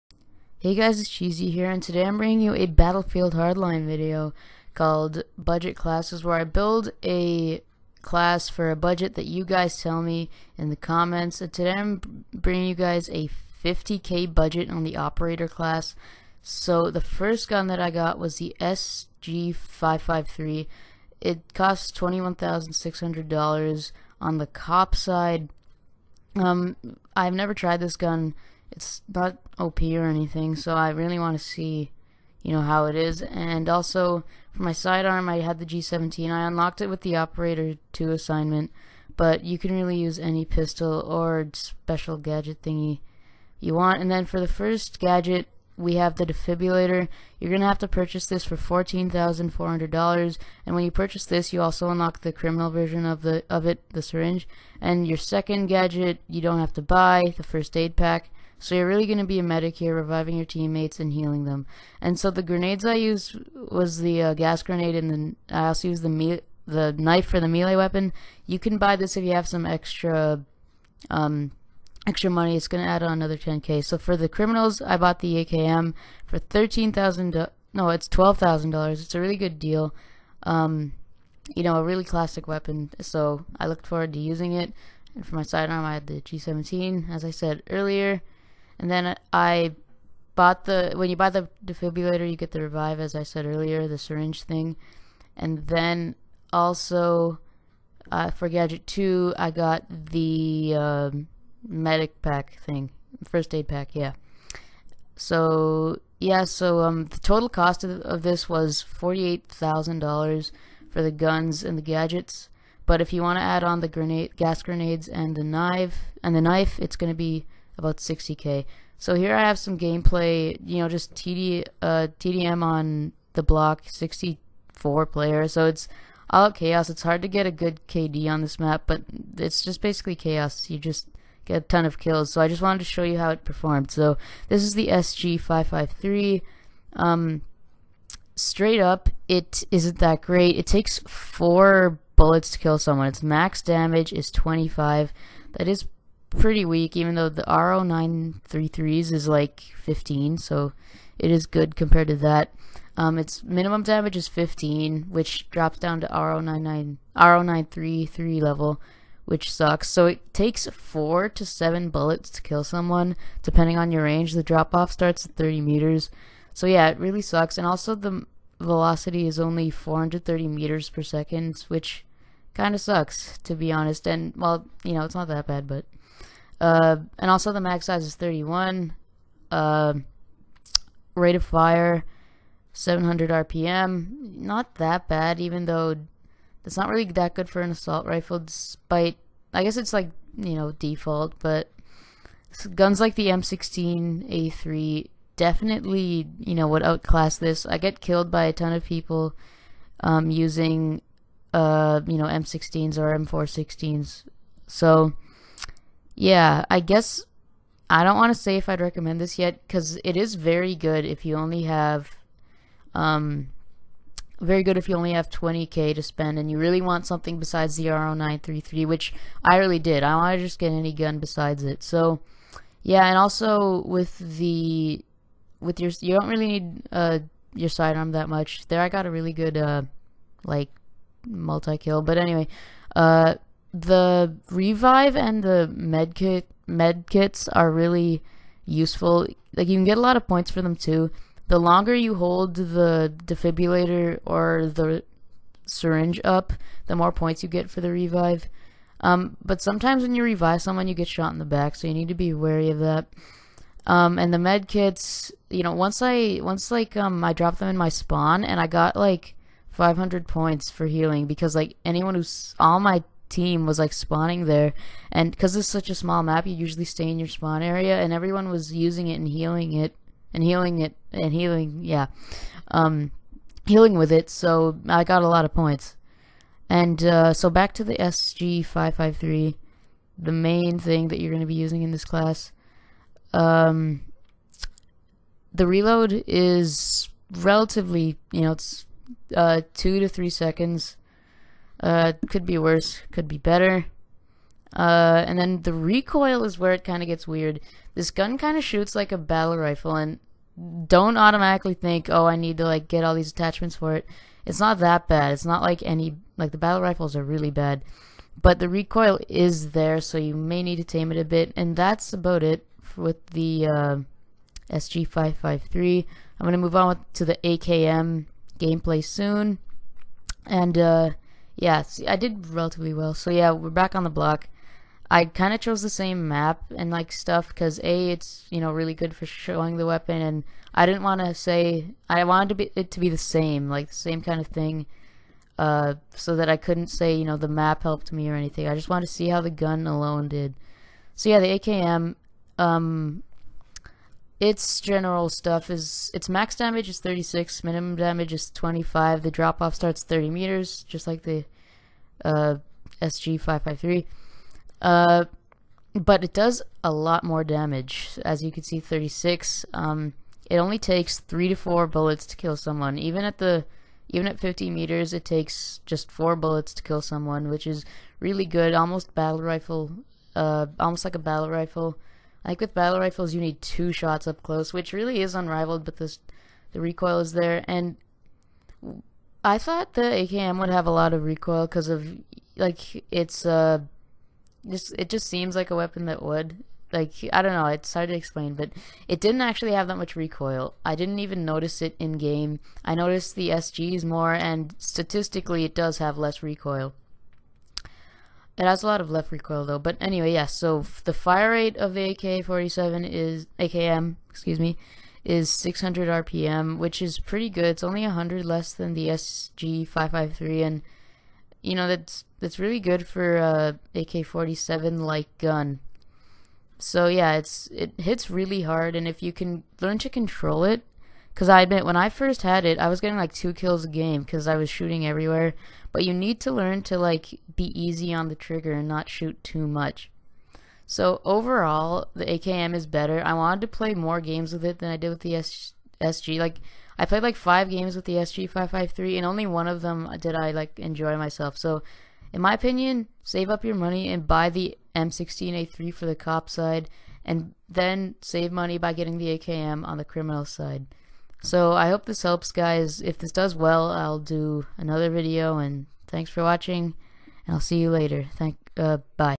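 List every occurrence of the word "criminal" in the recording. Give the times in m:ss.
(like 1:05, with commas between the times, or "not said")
0:52, 1:14, 7:30.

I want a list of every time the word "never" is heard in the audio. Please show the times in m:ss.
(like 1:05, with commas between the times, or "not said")
0:27.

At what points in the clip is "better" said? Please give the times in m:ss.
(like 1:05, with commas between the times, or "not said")
4:53, 7:12.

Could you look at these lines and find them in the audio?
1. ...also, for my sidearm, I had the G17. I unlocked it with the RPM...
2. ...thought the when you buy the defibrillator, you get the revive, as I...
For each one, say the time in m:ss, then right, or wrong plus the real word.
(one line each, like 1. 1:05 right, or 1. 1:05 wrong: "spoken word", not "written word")
1. 0:33 wrong: "Operator", not "RPM"
2. 1:30 wrong: "bought", not "thought".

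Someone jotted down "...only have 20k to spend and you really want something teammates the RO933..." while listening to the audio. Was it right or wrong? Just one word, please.
wrong.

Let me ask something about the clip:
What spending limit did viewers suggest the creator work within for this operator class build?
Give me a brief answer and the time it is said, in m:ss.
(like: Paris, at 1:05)
50k, at 0:13.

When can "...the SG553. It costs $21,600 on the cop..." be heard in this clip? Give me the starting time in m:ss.
0:18.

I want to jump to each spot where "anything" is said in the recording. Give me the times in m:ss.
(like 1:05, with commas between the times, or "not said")
0:30, 5:38.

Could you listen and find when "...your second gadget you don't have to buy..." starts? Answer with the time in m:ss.
0:55.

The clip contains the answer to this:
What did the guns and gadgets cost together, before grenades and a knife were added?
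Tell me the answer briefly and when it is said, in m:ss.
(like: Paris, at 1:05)
$48,000, at 1:48.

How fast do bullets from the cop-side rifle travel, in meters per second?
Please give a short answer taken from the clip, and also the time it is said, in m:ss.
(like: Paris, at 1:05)
430, at 2:49.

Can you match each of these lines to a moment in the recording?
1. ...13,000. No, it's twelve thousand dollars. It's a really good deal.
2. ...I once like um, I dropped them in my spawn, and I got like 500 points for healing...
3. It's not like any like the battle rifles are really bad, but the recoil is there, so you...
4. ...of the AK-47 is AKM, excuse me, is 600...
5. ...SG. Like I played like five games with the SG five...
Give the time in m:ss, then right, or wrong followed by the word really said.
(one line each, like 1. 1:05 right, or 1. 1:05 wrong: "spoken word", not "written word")
1. 1:16 right
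2. 4:16 right
3. 5:05 right
4. 6:41 right
5. 7:16 right.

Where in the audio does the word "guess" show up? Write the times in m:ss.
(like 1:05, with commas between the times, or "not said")
3:09, 3:26.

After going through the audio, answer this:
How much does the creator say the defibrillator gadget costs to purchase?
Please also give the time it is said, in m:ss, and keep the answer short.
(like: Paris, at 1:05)
$14,400, at 0:48.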